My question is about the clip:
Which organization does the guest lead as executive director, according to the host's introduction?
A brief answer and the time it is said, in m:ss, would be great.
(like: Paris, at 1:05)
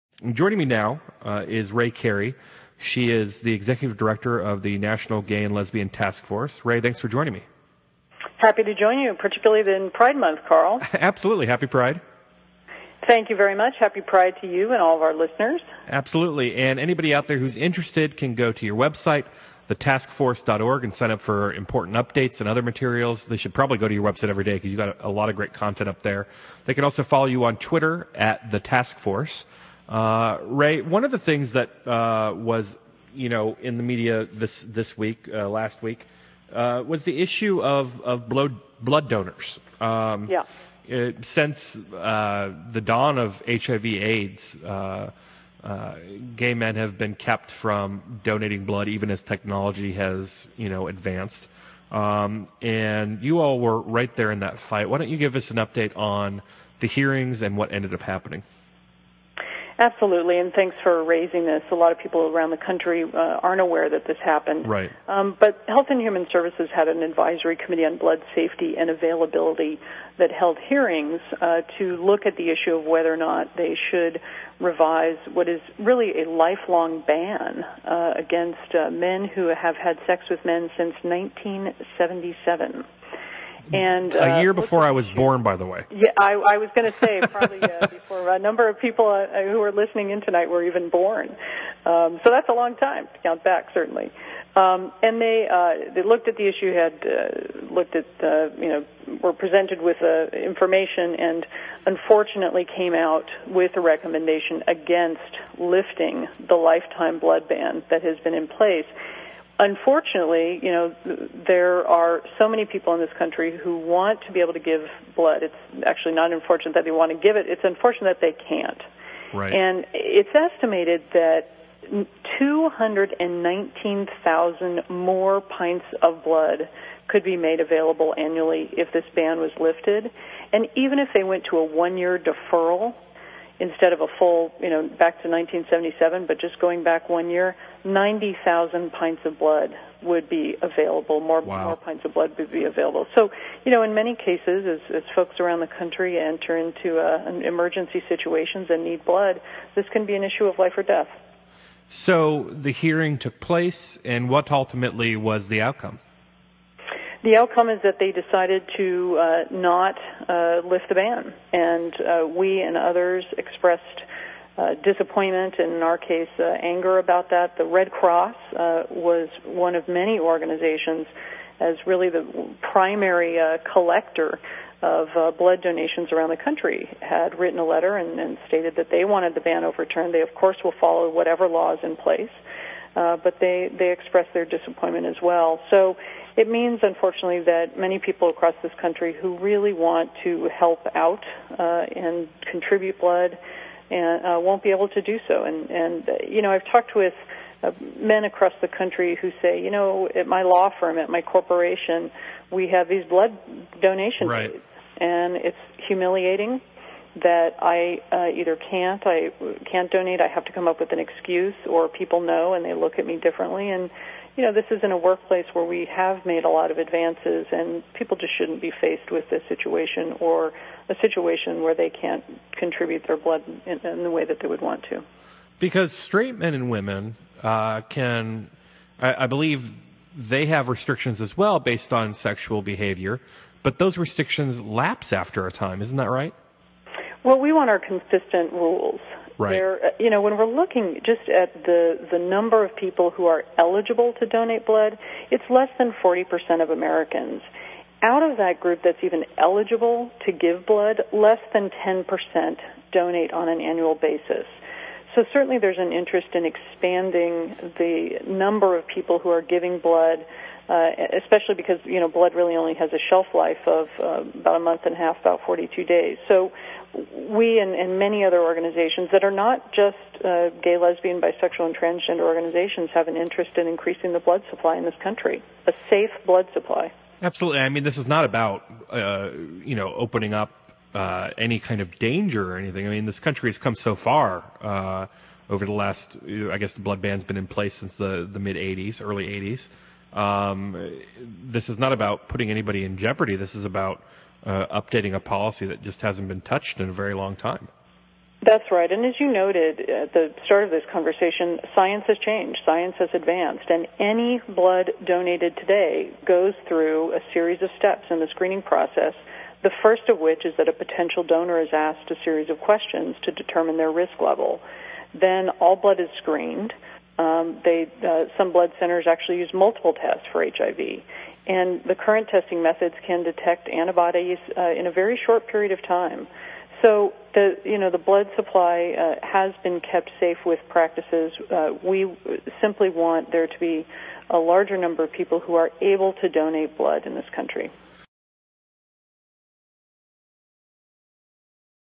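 National Gay and Lesbian Task Force, at 0:04.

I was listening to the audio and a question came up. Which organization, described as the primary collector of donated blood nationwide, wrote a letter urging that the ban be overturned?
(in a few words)
the Red Cross.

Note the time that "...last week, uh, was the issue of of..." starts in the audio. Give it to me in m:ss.
0:35.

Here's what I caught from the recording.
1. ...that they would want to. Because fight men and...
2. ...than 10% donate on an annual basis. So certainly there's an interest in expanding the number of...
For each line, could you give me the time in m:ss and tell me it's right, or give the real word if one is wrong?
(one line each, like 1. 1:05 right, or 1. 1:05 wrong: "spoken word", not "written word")
1. 3:44 wrong: "straight", not "fight"
2. 4:11 right.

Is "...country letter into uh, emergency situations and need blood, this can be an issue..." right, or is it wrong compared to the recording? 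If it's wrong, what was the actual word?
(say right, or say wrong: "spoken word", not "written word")
wrong: "enter", not "letter".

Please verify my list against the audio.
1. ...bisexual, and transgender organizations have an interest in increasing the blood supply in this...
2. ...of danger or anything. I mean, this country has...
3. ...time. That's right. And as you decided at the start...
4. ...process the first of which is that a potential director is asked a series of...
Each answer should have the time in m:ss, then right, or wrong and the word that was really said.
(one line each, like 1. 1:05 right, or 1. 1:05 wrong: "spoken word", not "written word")
1. 4:31 right
2. 4:41 right
3. 4:57 wrong: "noted", not "decided"
4. 5:08 wrong: "donor", not "director".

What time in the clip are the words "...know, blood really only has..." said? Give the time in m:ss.
4:21.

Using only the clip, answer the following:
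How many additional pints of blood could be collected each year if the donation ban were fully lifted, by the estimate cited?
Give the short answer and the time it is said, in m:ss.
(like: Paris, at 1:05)
219,000, at 2:02.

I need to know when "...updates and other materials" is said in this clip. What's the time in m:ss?
0:21.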